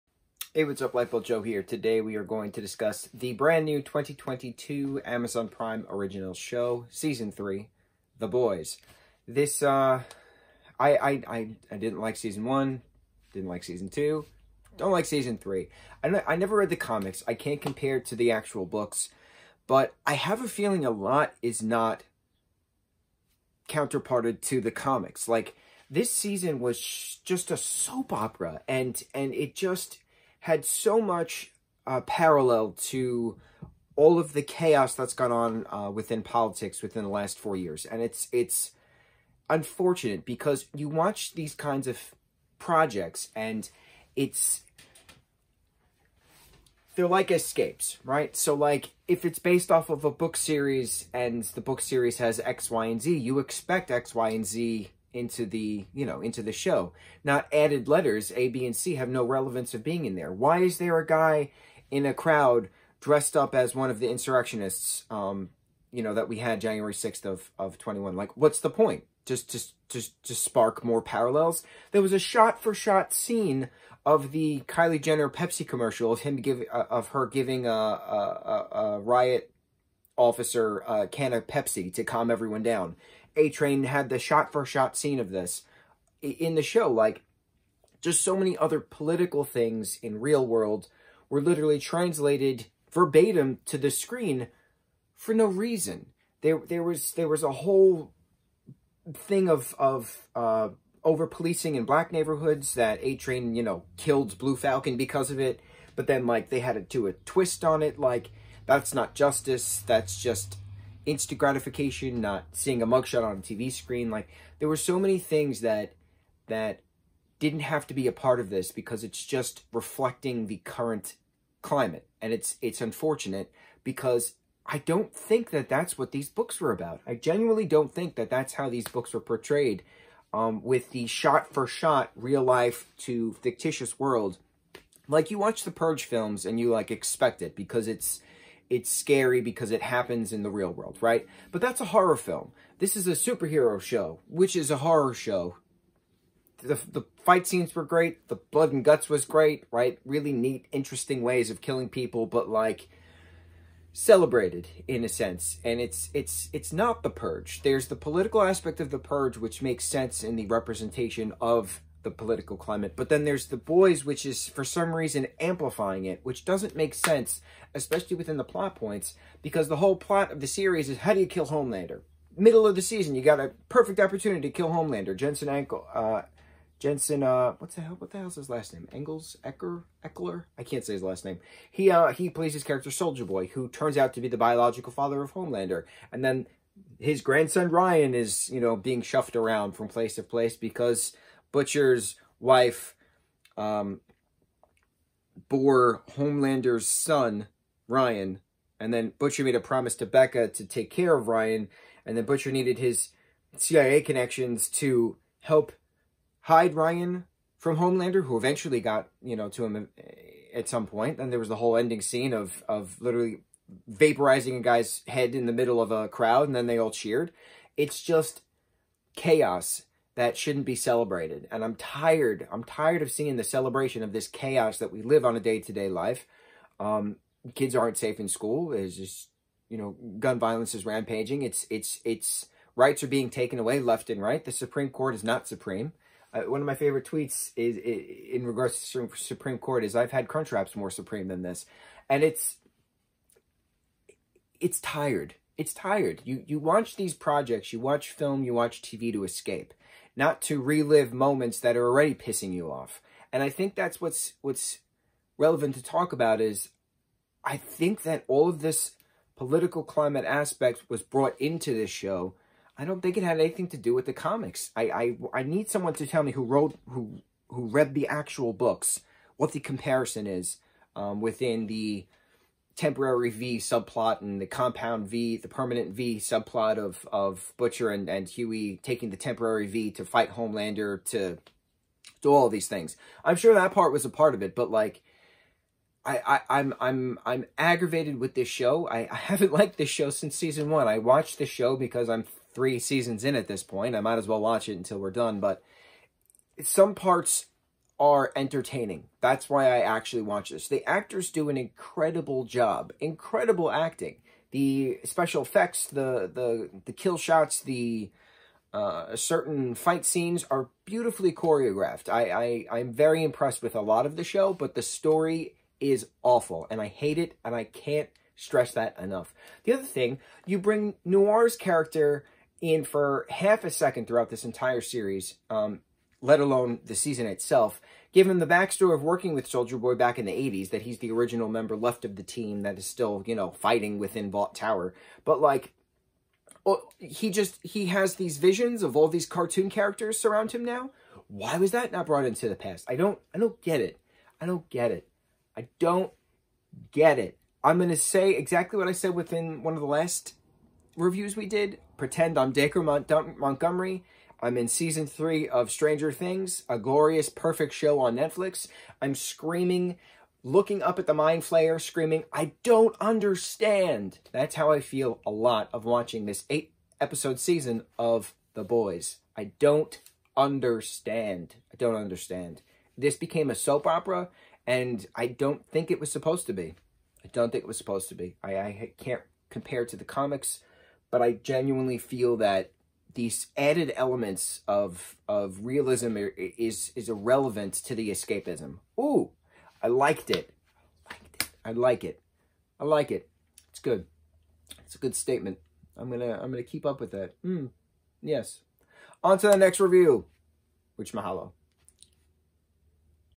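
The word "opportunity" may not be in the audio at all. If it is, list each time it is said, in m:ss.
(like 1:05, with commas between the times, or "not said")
2:53.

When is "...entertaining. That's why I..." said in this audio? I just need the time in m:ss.
4:58.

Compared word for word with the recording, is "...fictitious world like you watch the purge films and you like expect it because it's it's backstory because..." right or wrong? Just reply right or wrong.
wrong.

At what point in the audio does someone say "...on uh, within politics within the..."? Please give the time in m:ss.
0:35.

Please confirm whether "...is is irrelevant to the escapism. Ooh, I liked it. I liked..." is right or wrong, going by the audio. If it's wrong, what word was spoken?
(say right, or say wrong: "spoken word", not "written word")
right.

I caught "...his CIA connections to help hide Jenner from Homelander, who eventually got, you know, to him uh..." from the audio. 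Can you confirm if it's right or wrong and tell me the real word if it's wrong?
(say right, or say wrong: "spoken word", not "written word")
wrong: "Ryan", not "Jenner".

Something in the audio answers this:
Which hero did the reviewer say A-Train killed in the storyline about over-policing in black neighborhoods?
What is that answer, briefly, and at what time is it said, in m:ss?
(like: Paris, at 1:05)
Blue Falcon, at 1:44.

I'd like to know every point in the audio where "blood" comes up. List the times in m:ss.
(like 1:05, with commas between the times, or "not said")
2:28.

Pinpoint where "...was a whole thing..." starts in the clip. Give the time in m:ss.
1:37.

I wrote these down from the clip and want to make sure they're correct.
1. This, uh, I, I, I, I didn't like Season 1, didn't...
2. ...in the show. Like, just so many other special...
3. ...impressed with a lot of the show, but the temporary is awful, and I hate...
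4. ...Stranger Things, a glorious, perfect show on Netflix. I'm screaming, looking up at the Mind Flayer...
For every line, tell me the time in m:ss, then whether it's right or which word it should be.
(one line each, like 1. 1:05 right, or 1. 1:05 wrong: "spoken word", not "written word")
1. 0:09 right
2. 1:26 wrong: "political", not "special"
3. 5:13 wrong: "story", not "temporary"
4. 5:55 right.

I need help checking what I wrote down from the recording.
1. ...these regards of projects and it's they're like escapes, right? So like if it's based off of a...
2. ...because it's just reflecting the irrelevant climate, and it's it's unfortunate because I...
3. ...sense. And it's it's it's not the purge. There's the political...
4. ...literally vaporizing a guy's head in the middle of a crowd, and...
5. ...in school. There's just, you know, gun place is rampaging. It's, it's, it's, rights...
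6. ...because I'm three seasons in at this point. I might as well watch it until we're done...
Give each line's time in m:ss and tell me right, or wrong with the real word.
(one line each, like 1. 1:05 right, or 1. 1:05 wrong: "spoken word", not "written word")
1. 0:41 wrong: "kinds", not "regards"
2. 1:58 wrong: "current", not "irrelevant"
3. 2:35 right
4. 3:33 right
5. 3:48 wrong: "violence", not "place"
6. 4:51 right.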